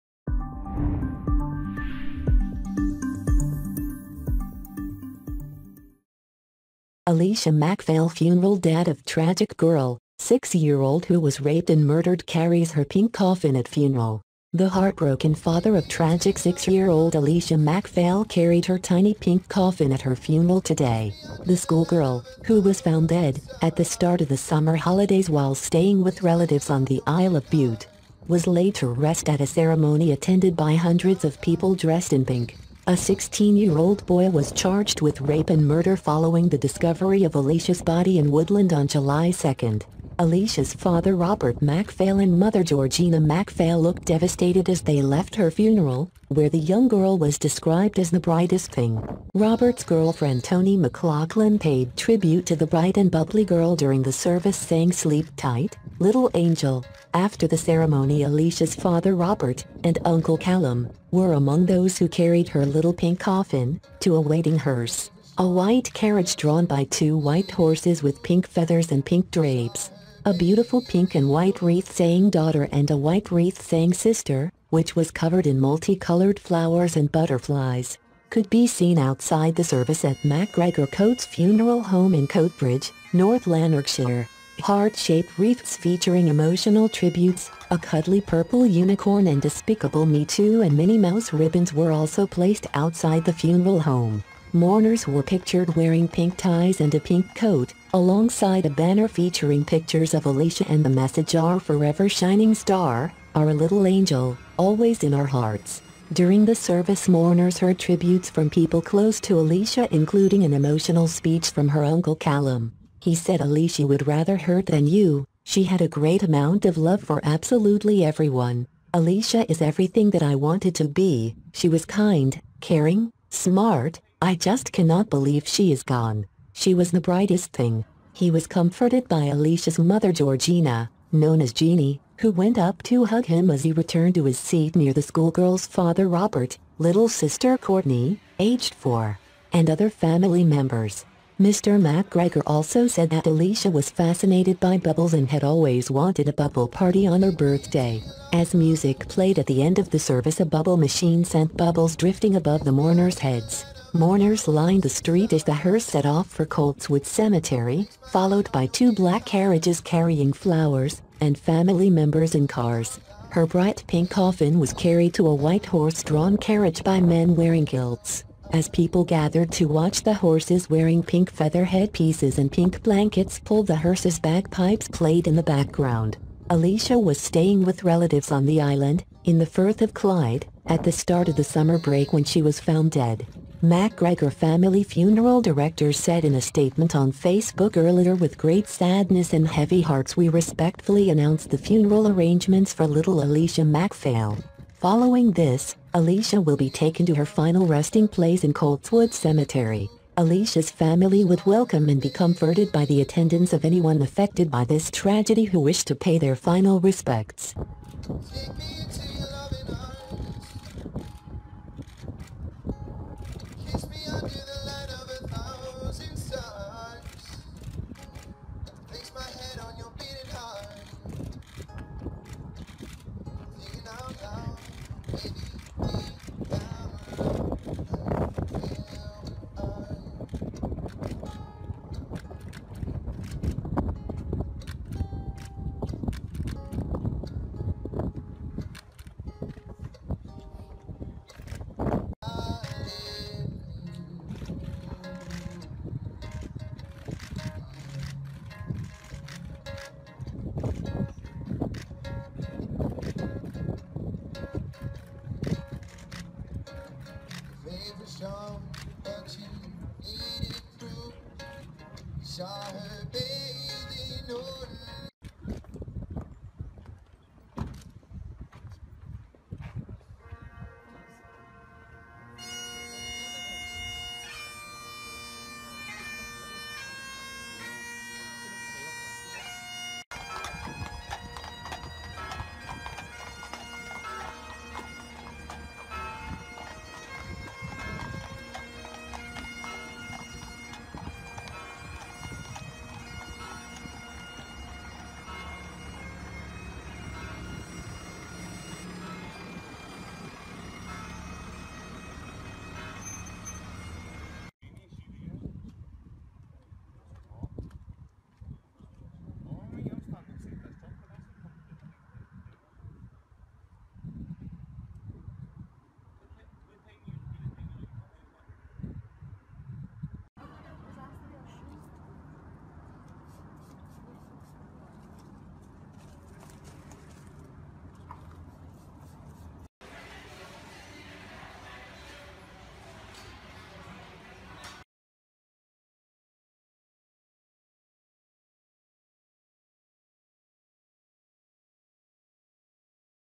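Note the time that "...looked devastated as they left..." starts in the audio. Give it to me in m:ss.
0:43.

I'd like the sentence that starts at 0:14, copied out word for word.
The heartbroken father of tragic six-year-old Alesha MacPhail carried her tiny pink coffin at her funeral today.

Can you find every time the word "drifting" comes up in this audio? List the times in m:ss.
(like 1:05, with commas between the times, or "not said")
2:31.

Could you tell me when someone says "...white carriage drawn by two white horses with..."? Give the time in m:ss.
1:05.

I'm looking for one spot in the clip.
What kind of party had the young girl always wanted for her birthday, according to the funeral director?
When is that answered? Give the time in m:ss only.
2:26.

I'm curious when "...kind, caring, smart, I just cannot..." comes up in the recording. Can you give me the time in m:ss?
2:01.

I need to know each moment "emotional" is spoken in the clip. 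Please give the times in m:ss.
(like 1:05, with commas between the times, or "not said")
1:26, 1:50.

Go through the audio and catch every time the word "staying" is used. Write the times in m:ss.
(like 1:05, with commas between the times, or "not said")
0:25, 2:57.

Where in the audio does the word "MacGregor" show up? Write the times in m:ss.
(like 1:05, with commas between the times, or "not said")
1:20, 2:21, 3:03.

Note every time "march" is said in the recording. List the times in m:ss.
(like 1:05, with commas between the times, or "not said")
not said.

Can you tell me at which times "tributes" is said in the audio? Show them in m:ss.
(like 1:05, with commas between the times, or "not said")
0:51, 1:26, 1:47.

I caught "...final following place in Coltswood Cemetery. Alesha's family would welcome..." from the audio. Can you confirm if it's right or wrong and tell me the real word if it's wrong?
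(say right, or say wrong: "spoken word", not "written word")
wrong: "resting", not "following".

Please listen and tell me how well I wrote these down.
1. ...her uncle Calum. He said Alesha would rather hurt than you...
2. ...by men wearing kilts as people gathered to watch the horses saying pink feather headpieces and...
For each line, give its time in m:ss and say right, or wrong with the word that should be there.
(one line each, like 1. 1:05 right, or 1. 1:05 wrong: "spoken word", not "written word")
1. 1:51 right
2. 2:46 wrong: "wearing", not "saying".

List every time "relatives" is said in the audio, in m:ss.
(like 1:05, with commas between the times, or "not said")
0:26, 2:57.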